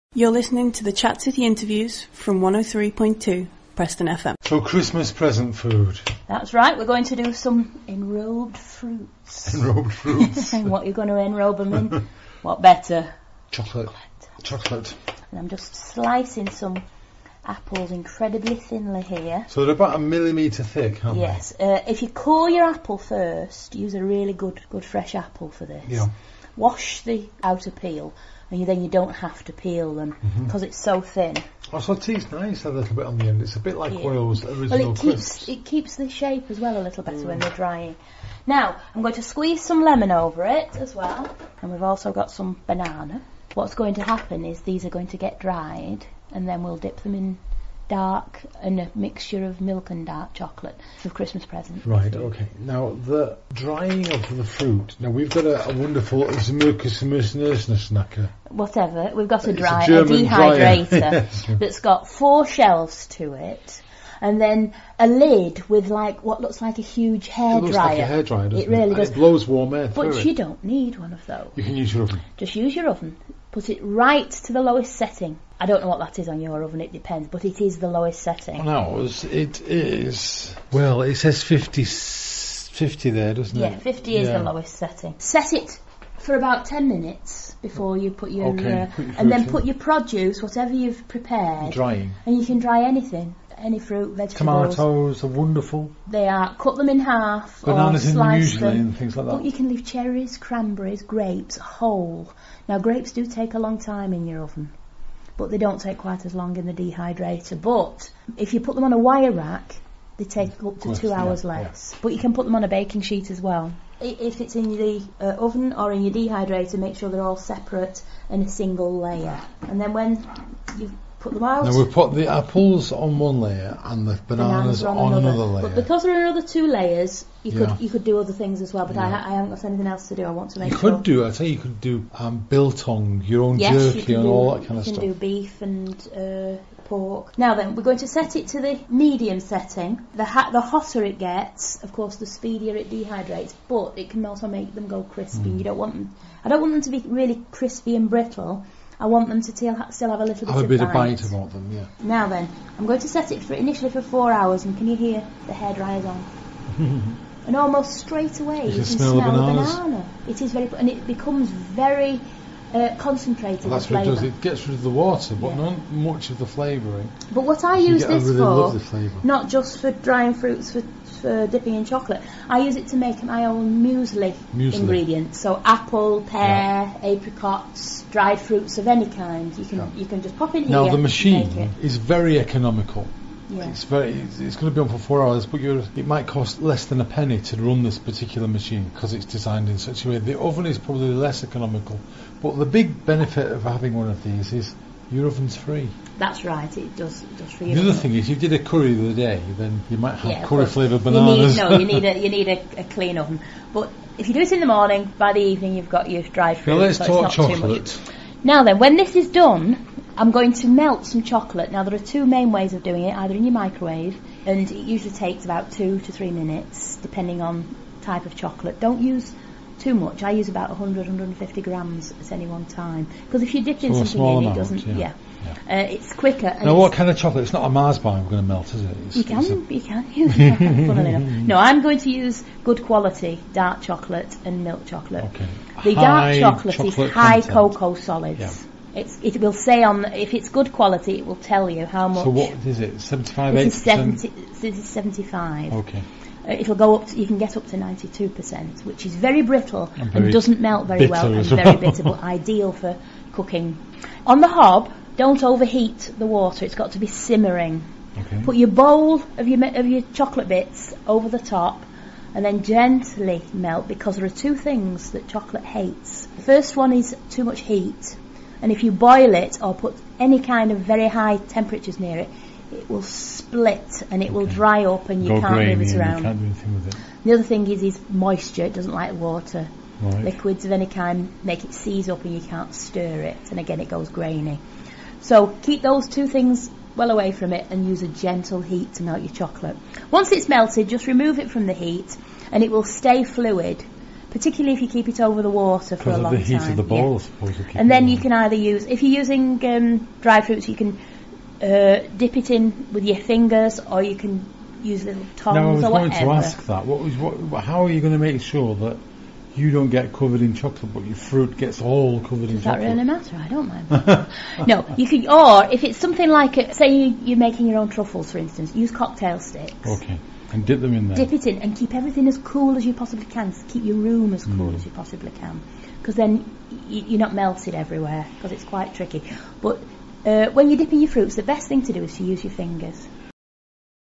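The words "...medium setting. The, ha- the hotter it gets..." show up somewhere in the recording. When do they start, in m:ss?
2:18.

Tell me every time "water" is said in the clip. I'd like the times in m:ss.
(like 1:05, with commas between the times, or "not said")
2:44, 4:16, 4:39, 4:55.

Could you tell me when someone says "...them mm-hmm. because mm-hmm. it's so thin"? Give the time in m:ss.
0:29.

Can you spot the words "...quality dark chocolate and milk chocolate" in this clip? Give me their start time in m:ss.
3:52.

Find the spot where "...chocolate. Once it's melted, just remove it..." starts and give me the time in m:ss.
4:49.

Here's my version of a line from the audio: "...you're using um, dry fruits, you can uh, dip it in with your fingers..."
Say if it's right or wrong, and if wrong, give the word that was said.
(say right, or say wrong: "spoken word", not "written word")
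right.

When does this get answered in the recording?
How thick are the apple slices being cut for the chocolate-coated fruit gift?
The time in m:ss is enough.
0:19.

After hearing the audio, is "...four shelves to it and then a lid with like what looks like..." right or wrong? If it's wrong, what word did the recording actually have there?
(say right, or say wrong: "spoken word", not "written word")
right.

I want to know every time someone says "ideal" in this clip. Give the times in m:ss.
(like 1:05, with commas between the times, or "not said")
4:12.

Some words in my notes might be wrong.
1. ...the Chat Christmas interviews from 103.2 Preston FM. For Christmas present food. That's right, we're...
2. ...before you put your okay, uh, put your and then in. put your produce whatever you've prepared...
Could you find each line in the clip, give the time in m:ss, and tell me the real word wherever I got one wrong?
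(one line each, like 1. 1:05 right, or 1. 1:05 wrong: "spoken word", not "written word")
1. 0:00 wrong: "City", not "Christmas"
2. 1:27 right.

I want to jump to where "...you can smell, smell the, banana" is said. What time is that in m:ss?
2:38.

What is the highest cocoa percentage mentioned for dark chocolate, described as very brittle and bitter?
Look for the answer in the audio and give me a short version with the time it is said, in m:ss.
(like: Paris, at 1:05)
92%, at 4:07.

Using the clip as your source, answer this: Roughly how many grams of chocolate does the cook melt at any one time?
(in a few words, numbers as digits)
100 to 150 grams.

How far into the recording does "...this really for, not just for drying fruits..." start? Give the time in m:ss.
2:48.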